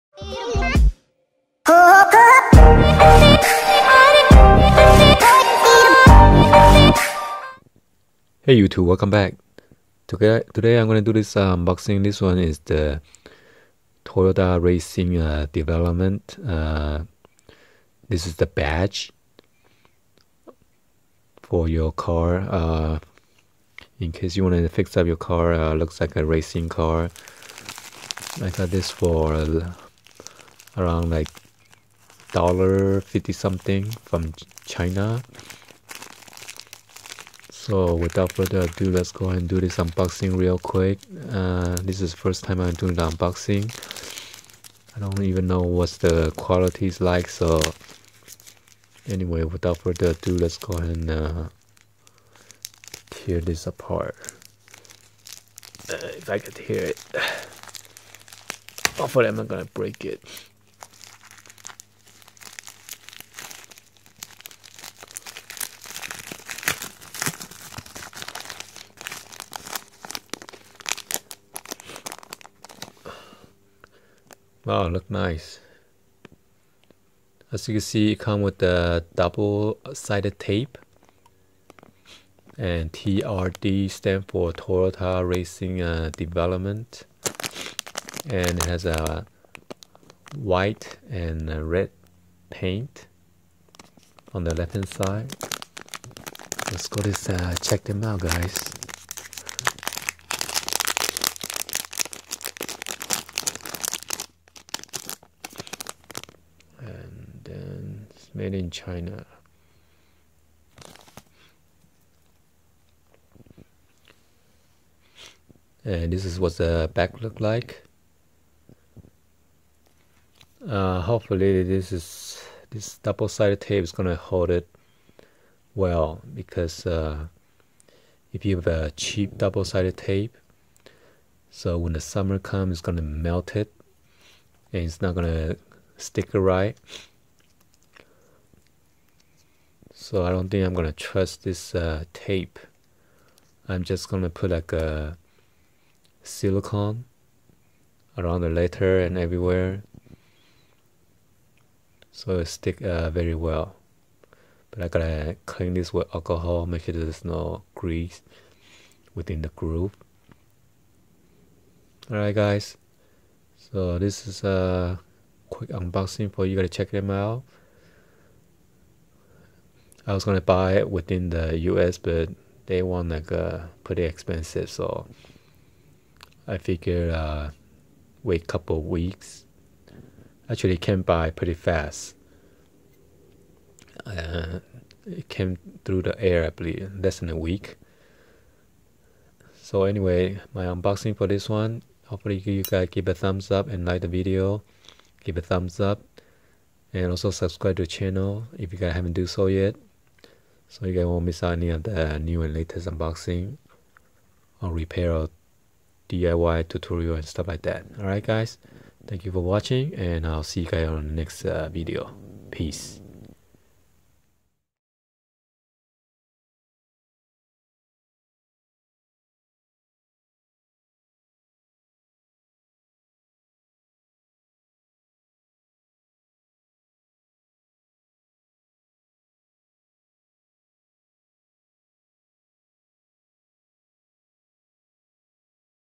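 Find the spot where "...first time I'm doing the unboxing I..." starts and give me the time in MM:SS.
00:42.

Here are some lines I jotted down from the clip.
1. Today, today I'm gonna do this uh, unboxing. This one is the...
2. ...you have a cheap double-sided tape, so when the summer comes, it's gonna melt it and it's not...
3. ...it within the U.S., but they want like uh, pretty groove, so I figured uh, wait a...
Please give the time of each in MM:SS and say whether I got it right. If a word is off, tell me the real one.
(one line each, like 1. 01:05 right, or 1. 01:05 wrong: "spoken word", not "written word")
1. 00:10 right
2. 02:08 right
3. 02:50 wrong: "expensive", not "groove".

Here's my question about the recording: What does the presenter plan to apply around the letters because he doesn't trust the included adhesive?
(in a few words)
Silicone.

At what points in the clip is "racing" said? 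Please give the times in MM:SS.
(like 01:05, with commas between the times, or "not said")
00:14, 00:26, 01:25.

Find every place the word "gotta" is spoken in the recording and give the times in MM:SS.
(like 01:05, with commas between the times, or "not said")
02:34, 02:46.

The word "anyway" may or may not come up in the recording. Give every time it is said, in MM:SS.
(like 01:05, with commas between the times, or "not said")
00:49, 03:09.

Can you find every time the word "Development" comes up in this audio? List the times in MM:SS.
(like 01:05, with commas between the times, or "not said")
00:15, 01:26.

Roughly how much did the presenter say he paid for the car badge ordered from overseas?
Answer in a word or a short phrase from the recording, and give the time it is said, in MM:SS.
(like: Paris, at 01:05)
$1.50, at 00:32.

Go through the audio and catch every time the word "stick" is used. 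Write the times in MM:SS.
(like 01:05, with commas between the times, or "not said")
02:15, 02:32.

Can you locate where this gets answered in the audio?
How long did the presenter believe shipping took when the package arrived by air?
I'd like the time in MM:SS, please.
03:06.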